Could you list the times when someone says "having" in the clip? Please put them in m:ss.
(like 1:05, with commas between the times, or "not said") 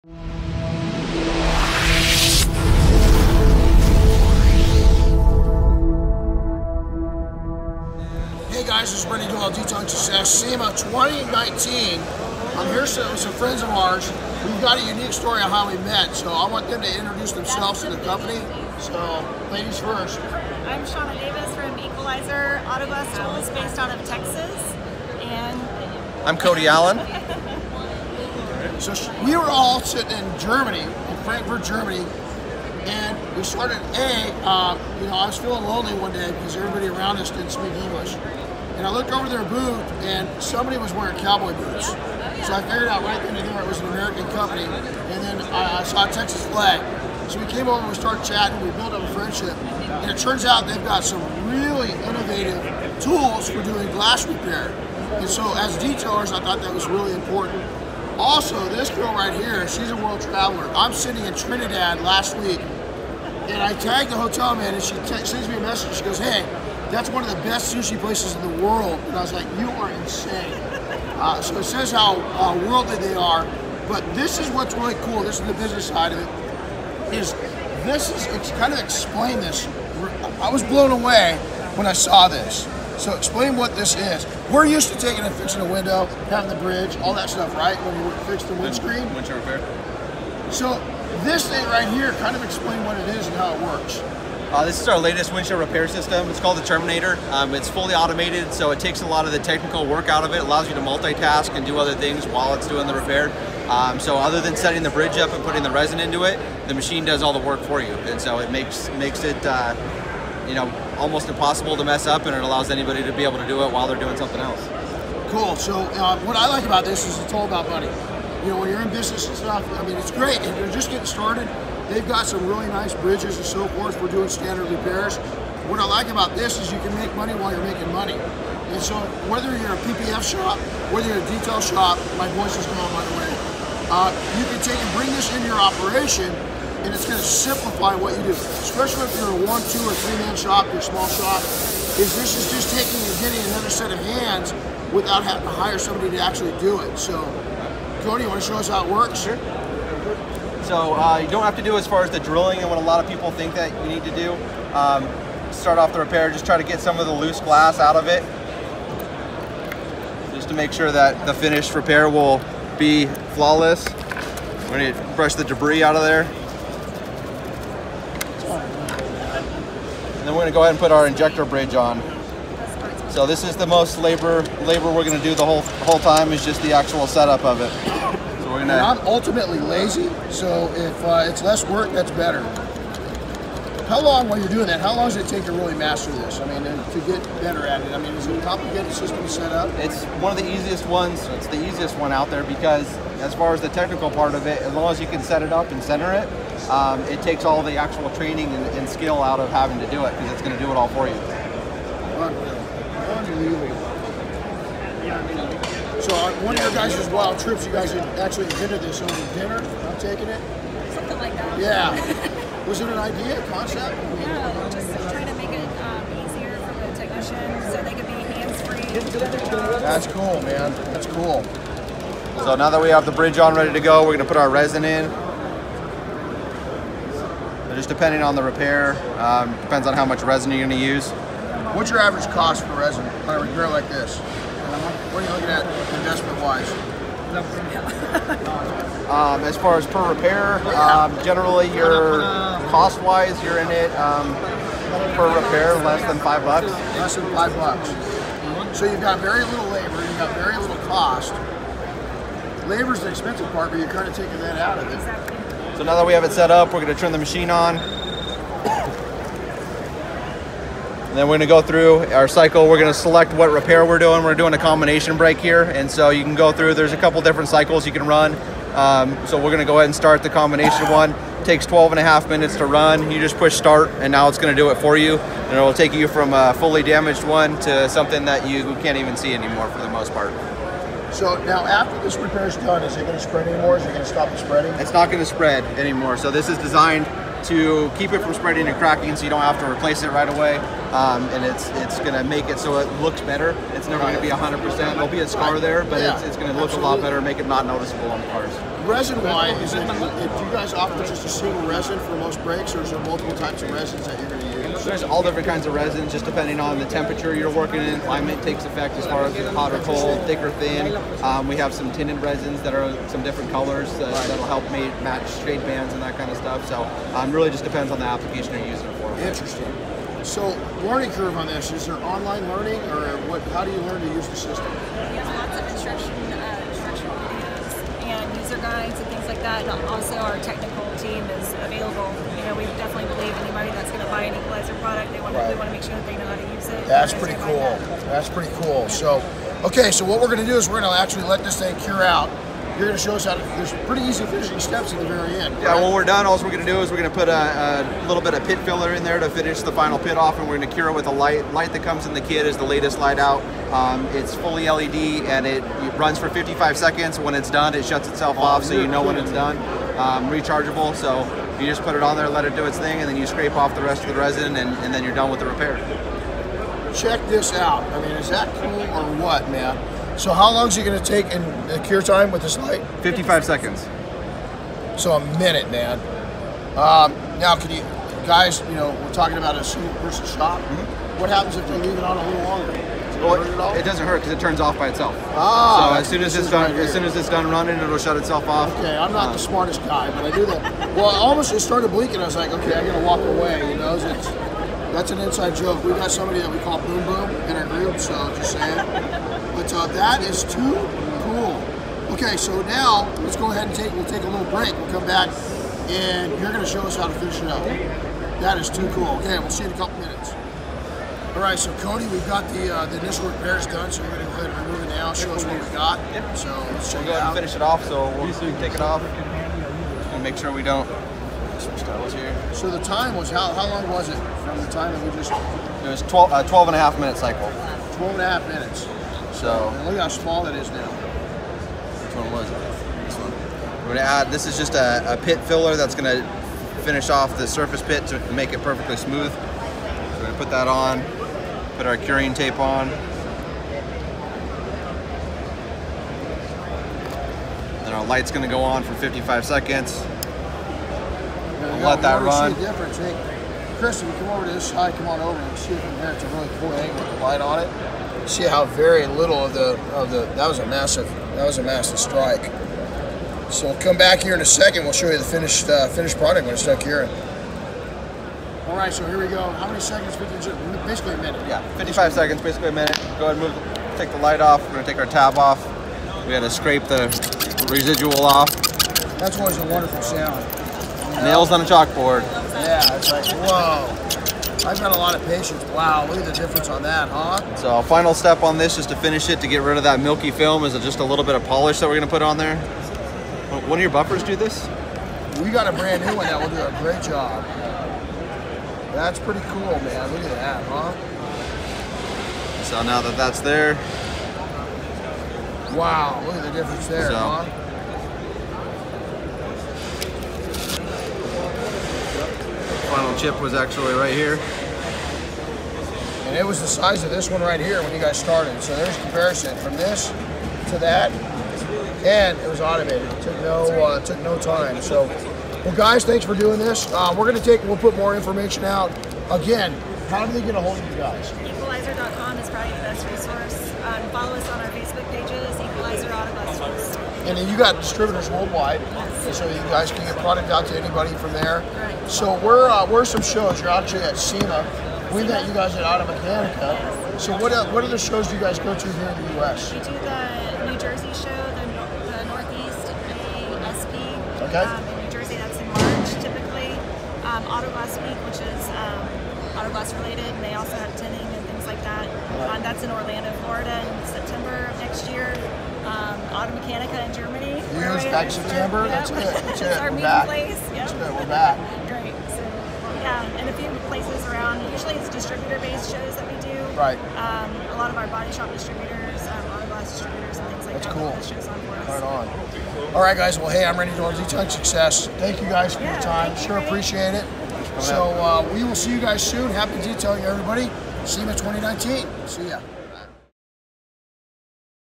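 1:26, 2:25, 3:19.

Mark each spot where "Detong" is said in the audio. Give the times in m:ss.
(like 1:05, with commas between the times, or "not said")
0:09.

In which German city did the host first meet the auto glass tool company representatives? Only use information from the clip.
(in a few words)
Frankfurt.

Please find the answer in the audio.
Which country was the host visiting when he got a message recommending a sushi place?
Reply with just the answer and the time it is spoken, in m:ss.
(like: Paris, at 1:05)
Trinidad, at 1:01.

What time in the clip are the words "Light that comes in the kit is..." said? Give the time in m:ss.
5:51.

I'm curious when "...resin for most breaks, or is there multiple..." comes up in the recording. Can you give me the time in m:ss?
5:01.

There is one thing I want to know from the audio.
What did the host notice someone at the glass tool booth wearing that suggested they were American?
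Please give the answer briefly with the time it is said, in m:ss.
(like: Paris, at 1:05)
Cowboy boots, at 0:41.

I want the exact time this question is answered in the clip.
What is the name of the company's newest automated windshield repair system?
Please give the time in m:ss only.
1:36.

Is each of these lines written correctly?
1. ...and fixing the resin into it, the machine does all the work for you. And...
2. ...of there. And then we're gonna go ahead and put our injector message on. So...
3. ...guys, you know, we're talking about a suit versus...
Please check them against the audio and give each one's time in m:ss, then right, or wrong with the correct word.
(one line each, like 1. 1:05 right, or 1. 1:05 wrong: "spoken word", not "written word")
1. 1:45 wrong: "putting", not "fixing"
2. 2:45 wrong: "bridge", not "message"
3. 6:18 right.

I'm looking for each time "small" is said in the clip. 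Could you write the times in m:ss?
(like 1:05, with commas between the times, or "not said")
2:20, 7:10.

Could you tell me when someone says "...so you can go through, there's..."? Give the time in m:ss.
4:25.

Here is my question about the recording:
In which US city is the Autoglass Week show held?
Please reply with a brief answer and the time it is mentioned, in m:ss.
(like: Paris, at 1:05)
Orlando, Florida, at 9:22.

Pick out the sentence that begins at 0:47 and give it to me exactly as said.
So we came over and we started chatting.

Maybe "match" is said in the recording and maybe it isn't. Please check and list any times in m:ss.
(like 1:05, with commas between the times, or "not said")
5:15.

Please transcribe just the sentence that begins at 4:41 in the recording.
So now after this repair is done, is it going to spread anymore?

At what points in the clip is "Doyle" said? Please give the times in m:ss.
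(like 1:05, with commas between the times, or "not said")
0:09, 9:43.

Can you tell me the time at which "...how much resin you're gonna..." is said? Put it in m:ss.
3:49.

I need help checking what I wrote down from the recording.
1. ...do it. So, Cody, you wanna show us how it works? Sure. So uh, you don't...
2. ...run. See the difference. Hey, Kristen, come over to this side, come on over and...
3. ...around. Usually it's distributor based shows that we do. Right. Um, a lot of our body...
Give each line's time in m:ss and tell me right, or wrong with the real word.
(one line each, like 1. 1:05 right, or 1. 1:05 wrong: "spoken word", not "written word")
1. 2:26 right
2. 7:32 right
3. 9:34 right.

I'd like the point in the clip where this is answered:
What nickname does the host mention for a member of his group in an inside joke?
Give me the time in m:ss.
6:36.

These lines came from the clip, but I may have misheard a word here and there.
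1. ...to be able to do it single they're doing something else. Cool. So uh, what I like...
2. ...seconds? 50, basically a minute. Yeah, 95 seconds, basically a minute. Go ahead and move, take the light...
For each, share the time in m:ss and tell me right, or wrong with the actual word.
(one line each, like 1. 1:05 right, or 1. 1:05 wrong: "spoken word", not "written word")
1. 1:53 wrong: "while", not "single"
2. 7:49 wrong: "55", not "95".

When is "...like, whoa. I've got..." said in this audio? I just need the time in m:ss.
8:03.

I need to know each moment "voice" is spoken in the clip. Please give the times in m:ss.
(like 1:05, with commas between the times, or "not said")
2:12.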